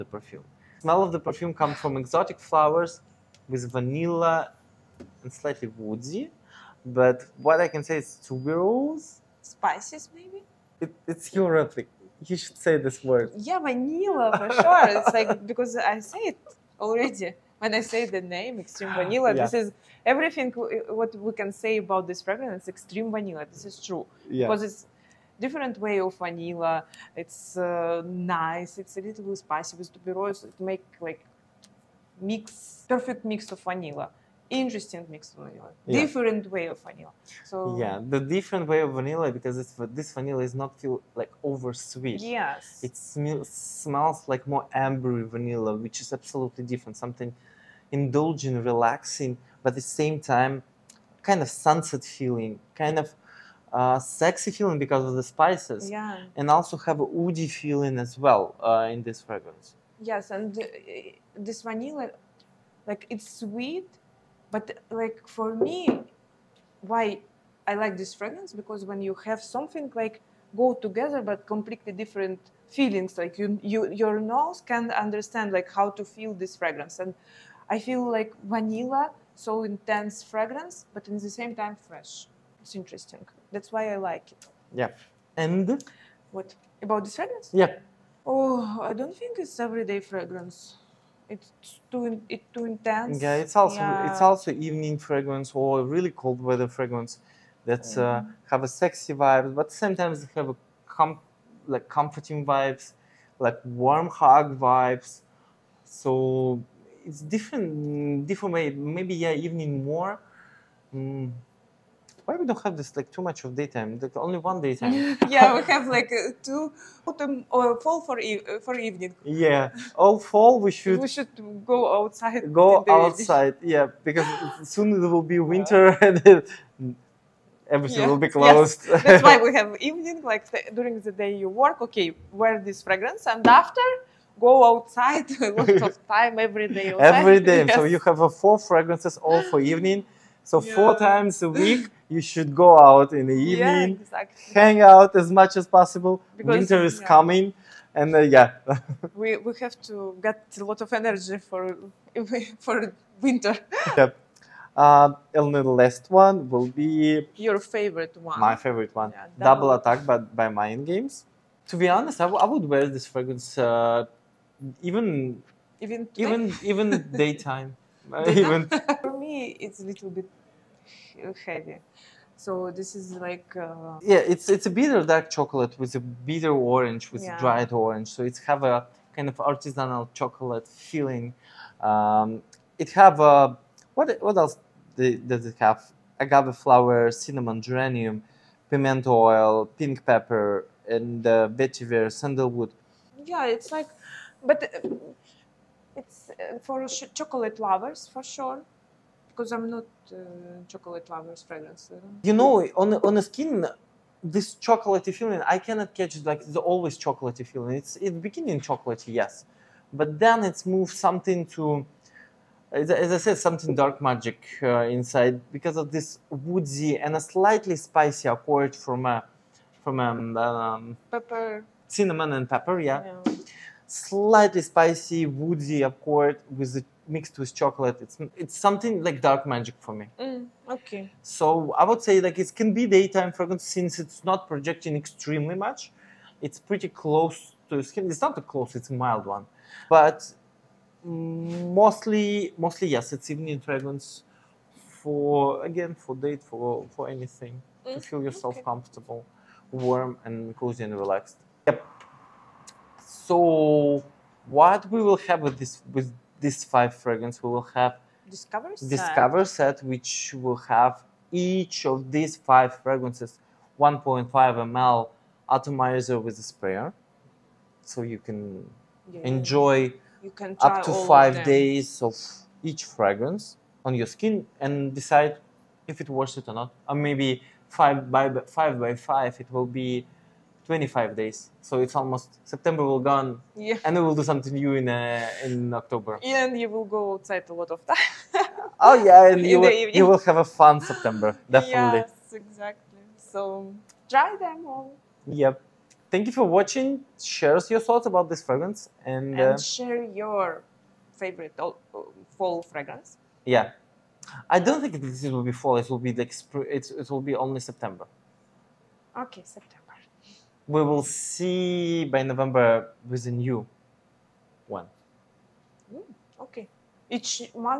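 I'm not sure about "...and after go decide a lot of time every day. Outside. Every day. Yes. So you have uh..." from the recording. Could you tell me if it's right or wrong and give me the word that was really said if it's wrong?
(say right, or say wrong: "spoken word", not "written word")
wrong: "outside", not "decide".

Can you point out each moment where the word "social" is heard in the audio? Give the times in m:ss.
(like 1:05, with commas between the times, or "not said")
not said.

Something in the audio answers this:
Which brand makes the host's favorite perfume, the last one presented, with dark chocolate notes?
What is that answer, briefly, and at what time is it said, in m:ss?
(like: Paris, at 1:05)
Mind Games, at 2:40.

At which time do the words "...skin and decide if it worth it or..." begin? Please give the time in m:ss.
4:34.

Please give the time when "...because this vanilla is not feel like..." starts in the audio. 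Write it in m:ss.
0:39.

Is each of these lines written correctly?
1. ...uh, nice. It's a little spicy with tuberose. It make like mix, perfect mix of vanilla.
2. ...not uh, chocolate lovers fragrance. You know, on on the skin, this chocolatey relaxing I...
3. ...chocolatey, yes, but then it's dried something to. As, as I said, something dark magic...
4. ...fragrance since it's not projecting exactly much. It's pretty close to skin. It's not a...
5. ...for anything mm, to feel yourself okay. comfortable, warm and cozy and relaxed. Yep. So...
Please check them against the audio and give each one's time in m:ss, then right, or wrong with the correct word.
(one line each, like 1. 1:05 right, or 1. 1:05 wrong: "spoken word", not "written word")
1. 0:27 right
2. 3:19 wrong: "feeling", not "relaxing"
3. 3:28 wrong: "moved", not "dried"
4. 3:53 wrong: "extremely", not "exactly"
5. 4:06 right.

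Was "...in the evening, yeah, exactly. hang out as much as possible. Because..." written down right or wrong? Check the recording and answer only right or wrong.
right.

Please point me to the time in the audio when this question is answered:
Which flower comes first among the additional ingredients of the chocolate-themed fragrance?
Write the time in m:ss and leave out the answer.
3:06.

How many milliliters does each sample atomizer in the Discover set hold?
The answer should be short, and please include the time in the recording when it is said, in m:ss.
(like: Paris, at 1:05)
1.5 ml, at 4:23.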